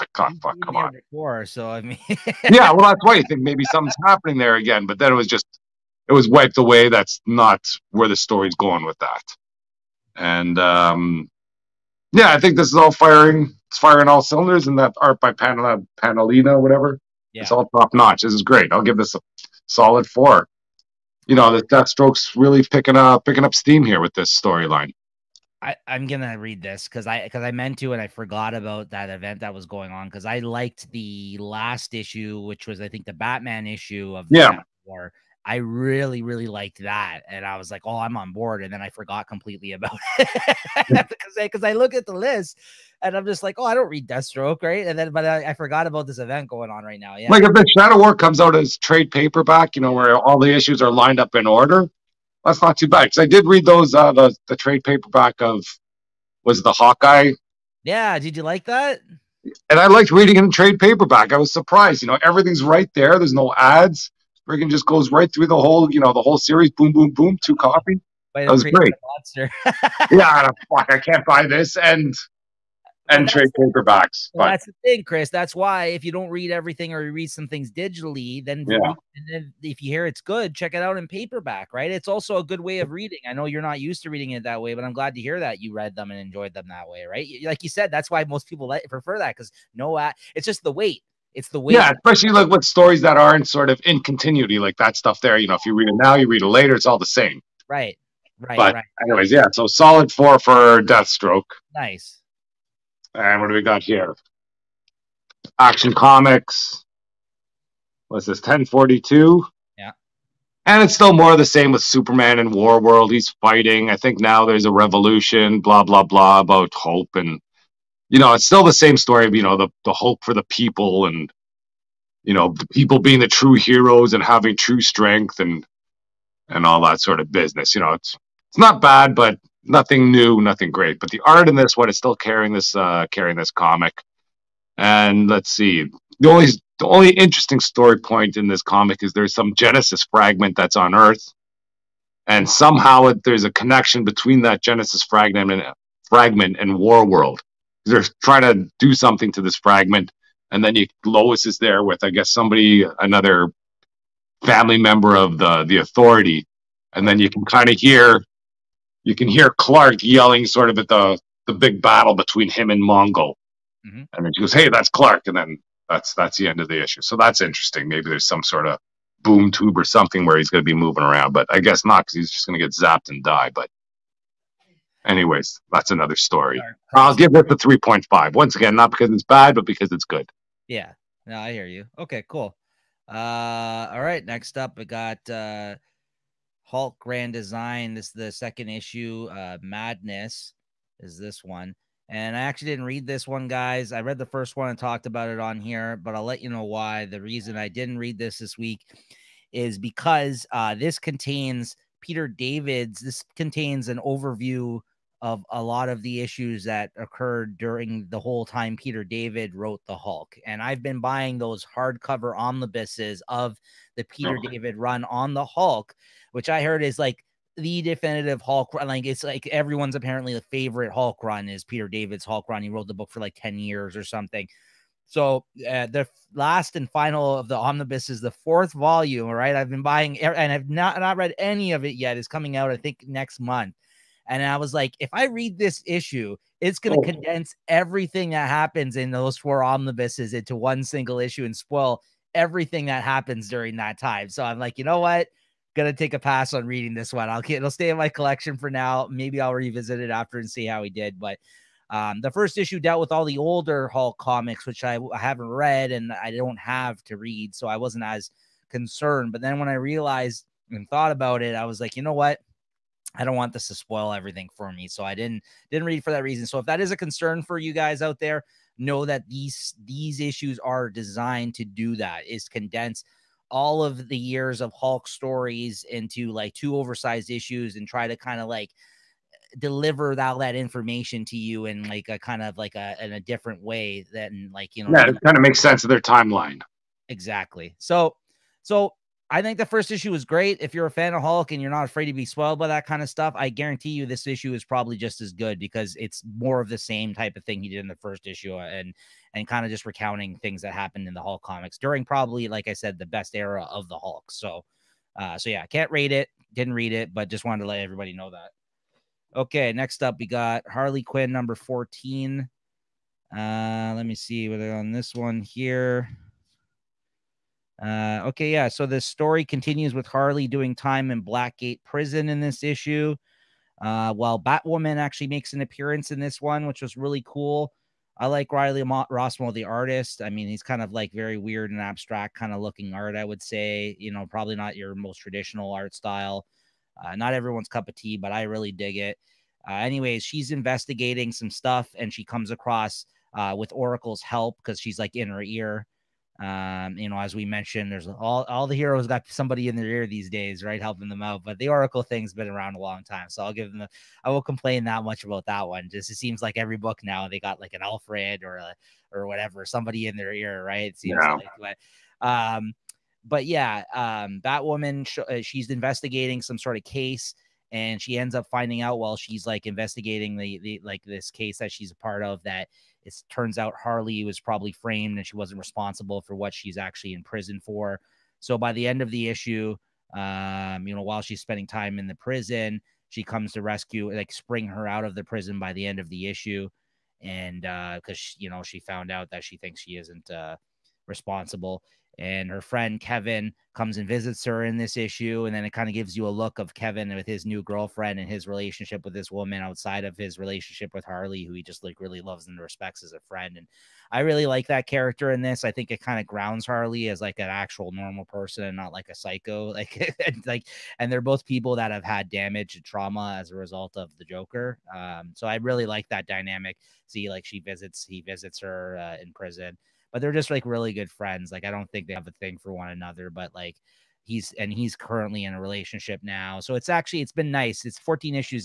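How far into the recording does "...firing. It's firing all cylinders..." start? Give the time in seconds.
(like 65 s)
12 s.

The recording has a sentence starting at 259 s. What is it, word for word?
But then when I realized and thought about it, I was like, you know what?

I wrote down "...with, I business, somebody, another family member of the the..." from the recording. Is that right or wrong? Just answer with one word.
wrong.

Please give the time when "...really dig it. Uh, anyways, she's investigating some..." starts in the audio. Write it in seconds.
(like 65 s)
338 s.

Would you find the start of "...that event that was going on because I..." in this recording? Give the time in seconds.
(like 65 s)
28 s.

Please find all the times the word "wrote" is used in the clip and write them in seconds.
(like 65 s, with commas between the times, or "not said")
209 s, 222 s.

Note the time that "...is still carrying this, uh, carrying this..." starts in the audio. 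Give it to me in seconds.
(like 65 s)
131 s.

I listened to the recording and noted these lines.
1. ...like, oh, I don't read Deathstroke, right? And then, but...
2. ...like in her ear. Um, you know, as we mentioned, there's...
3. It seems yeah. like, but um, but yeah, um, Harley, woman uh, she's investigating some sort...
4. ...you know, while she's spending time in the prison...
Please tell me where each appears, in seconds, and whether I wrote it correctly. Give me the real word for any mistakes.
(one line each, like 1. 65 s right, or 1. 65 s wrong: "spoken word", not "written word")
1. 43 s right
2. 344 s right
3. 360 s wrong: "Batwoman", not "Harley"
4. 380 s right.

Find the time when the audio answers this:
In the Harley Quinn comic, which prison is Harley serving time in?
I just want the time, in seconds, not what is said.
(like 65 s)
321 s.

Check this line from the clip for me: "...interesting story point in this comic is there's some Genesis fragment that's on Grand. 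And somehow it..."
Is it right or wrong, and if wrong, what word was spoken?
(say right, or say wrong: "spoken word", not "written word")
wrong: "Earth", not "Grand".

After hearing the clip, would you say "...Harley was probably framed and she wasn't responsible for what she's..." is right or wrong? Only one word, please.
right.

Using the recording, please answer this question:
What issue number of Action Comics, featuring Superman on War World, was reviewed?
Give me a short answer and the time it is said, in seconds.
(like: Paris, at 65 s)
1042, at 108 s.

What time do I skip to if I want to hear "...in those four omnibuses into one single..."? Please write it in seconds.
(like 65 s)
238 s.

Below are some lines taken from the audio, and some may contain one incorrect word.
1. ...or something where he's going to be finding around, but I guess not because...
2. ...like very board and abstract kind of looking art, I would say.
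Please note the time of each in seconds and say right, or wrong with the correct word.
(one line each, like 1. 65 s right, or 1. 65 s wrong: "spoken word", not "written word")
1. 169 s wrong: "moving", not "finding"
2. 330 s wrong: "weird", not "board".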